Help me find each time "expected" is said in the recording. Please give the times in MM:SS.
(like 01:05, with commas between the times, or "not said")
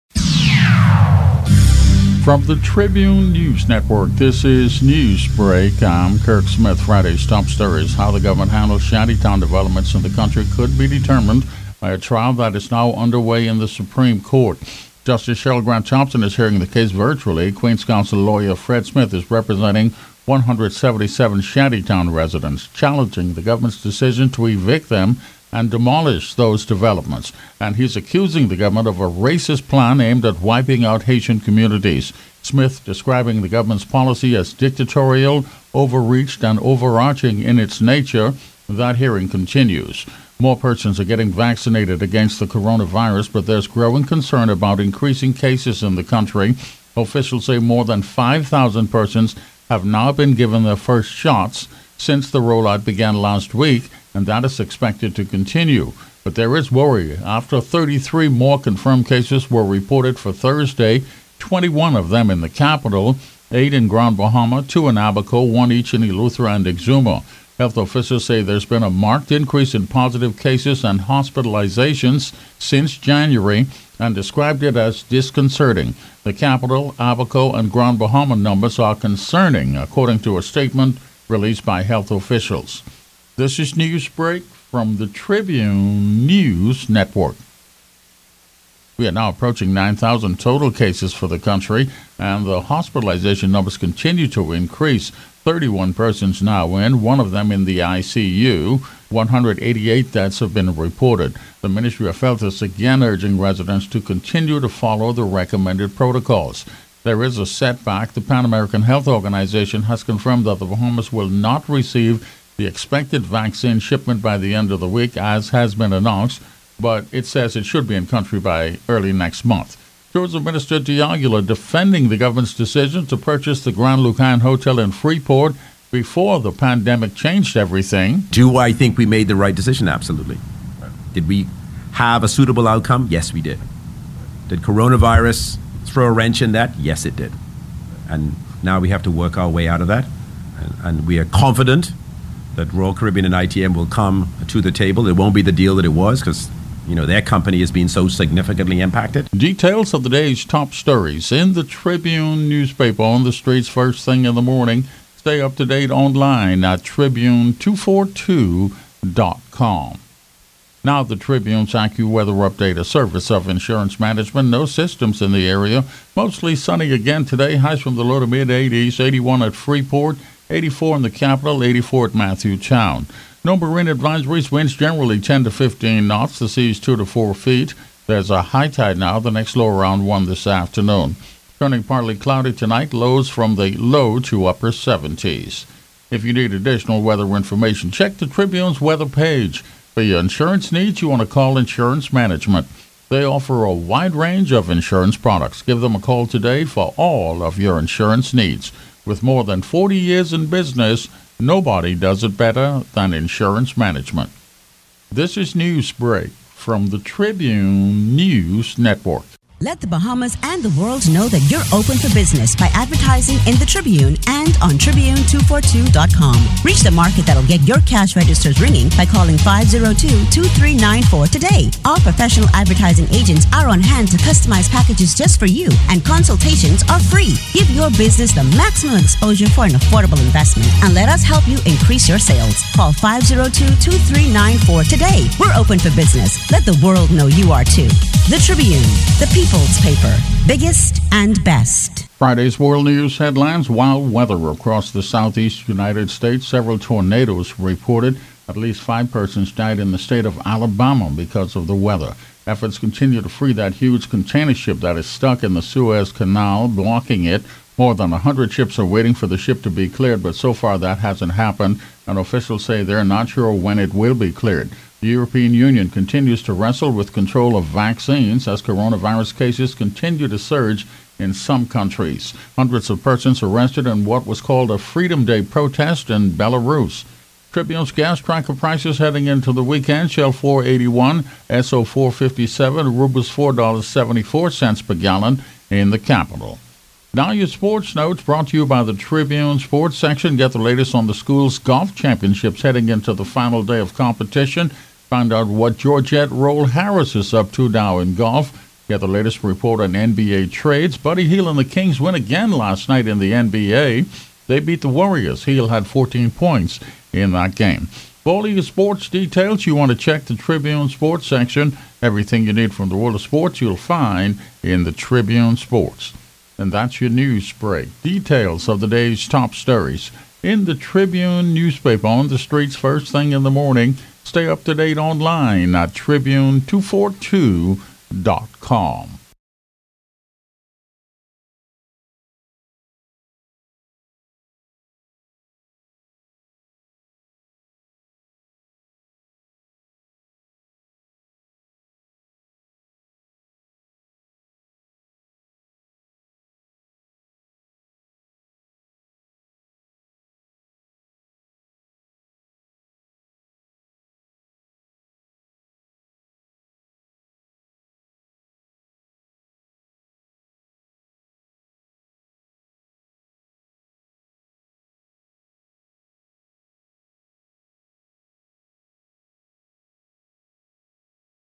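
00:54, 01:52.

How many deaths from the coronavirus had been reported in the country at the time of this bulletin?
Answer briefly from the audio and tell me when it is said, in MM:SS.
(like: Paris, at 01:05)
188, at 01:39.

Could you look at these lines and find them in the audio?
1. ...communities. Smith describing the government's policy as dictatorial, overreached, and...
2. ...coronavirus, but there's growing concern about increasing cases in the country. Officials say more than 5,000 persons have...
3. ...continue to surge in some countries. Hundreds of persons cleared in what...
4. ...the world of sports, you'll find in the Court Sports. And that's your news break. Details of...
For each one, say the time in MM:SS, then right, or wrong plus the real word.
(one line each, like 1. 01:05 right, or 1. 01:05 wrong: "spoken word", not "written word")
1. 00:31 right
2. 00:42 right
3. 04:29 wrong: "arrested", not "cleared"
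4. 05:12 wrong: "Tribune", not "Court".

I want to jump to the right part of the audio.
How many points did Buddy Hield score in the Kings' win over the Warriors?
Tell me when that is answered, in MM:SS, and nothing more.
05:05.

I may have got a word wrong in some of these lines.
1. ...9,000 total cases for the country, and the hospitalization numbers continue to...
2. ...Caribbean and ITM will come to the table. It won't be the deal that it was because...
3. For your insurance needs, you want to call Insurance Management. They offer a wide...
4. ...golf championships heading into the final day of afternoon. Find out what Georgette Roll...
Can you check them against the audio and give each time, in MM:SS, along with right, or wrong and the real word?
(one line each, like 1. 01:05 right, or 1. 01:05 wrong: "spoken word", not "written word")
1. 01:29 right
2. 02:22 right
3. 03:09 right
4. 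04:51 wrong: "competition", not "afternoon".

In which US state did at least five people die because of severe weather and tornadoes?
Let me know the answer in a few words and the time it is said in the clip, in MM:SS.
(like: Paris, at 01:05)
Alabama, at 04:10.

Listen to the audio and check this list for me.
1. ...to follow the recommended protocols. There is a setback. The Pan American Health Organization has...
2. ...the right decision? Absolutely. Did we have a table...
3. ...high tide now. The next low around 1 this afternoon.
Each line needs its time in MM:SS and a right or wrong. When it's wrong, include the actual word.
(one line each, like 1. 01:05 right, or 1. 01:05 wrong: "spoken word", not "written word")
1. 01:44 right
2. 02:09 wrong: "suitable", not "table"
3. 02:58 right.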